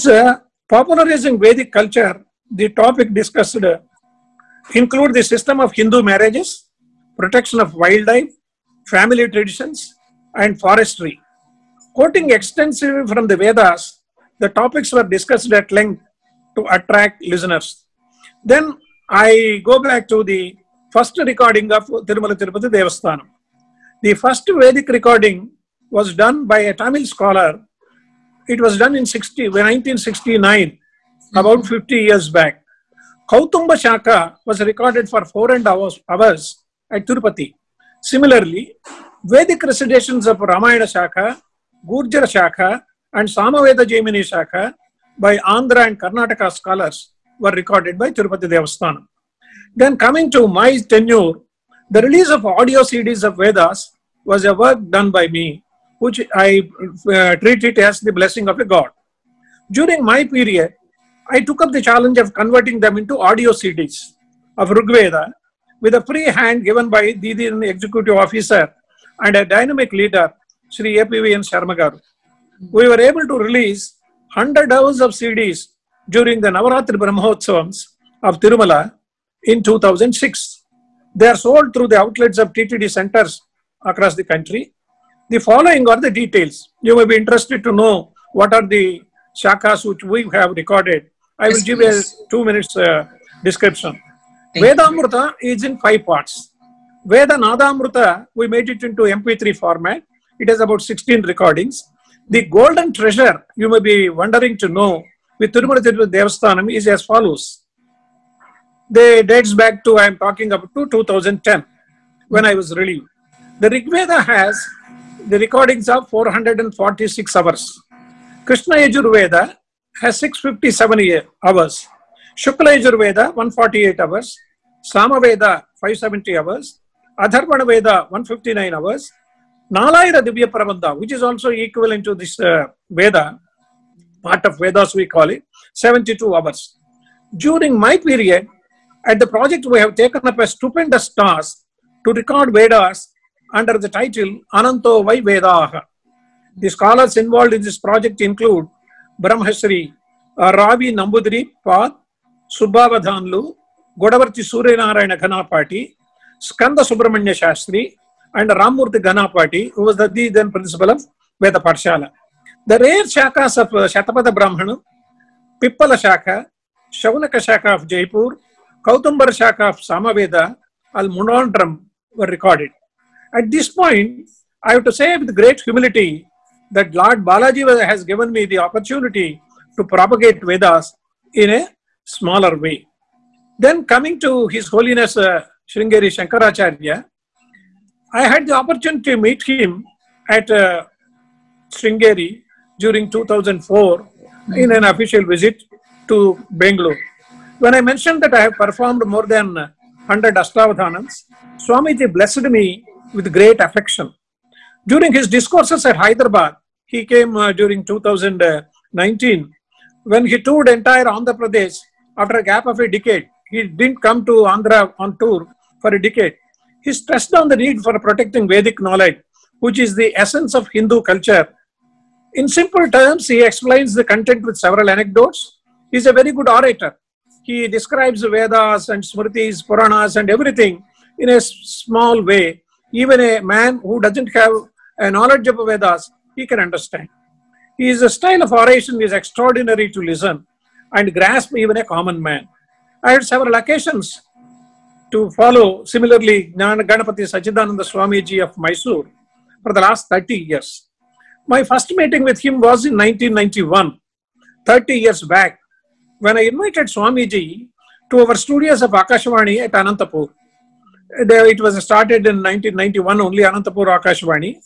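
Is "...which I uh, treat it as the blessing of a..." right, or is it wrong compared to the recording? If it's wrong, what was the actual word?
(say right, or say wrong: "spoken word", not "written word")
right.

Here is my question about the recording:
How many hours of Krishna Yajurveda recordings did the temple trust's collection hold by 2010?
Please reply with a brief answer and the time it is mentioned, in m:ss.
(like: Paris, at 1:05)
657, at 2:00.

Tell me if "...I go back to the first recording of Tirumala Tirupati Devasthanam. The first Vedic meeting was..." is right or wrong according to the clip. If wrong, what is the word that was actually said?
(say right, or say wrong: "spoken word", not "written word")
wrong: "recording", not "meeting".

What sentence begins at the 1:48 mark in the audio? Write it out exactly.
They dates back to, I'm talking up to 2010 when I was relieved.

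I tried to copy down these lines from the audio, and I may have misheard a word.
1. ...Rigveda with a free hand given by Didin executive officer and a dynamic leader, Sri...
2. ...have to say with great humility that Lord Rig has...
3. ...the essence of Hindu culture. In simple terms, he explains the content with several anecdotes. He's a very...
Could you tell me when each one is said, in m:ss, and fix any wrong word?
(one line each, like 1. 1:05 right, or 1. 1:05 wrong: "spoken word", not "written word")
1. 1:04 right
2. 2:54 wrong: "Balaji", not "Rig"
3. 3:39 right.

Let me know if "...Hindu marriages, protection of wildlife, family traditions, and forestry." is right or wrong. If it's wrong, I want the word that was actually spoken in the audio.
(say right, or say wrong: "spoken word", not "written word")
right.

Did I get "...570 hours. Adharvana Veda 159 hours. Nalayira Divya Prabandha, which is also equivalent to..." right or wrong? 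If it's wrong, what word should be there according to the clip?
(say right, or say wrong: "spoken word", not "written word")
right.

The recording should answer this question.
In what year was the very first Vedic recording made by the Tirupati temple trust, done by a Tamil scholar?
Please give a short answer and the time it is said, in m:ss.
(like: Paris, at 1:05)
1969, at 0:29.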